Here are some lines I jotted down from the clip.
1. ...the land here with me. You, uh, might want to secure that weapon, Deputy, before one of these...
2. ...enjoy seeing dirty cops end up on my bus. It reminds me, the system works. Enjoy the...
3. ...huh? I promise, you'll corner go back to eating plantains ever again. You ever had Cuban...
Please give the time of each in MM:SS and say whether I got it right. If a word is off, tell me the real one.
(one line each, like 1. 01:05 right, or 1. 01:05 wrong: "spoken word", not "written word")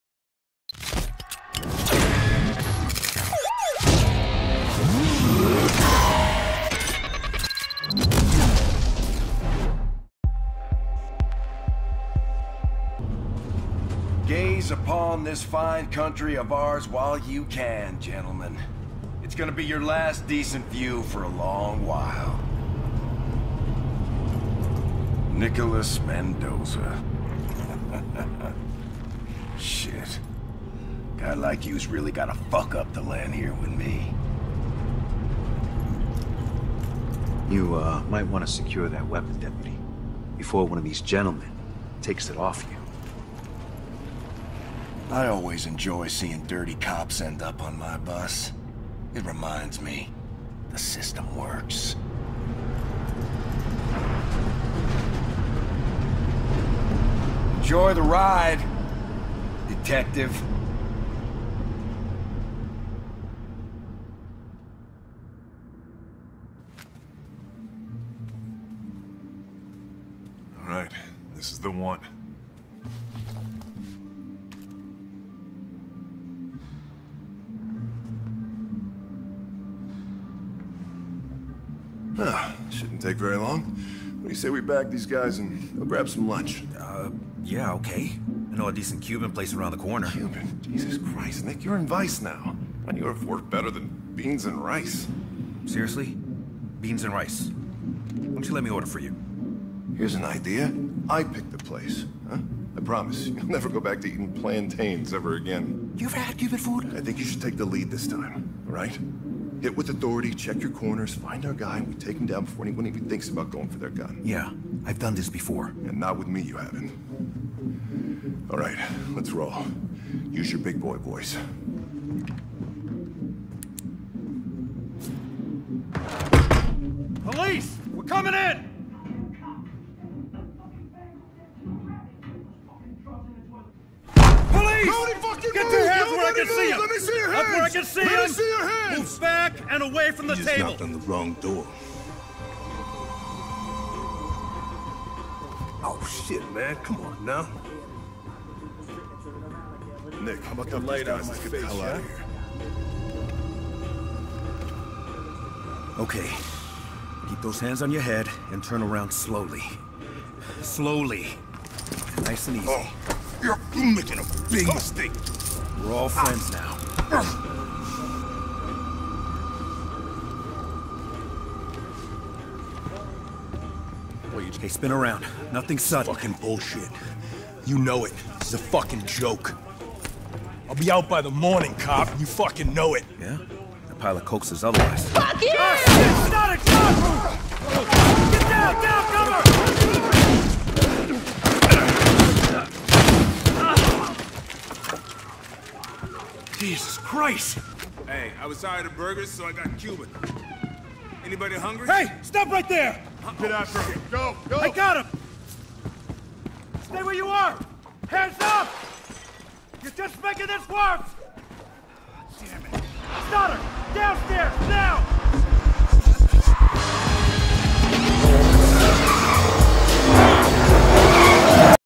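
1. 00:32 right
2. 00:45 right
3. 01:42 wrong: "never", not "corner".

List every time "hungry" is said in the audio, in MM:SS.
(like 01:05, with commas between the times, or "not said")
03:21.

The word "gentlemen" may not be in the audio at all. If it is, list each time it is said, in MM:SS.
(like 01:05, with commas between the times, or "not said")
00:17, 00:41.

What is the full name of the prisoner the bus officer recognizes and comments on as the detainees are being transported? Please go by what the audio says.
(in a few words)
Nicholas Mendoza.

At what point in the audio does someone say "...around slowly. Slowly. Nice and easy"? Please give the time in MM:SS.
02:38.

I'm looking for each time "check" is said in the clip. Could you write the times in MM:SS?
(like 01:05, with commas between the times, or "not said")
01:50.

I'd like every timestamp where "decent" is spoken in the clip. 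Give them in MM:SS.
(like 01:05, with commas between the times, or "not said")
00:20, 01:28.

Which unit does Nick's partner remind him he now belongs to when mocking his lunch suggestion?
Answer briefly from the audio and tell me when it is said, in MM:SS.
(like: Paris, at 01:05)
Vice, at 01:31.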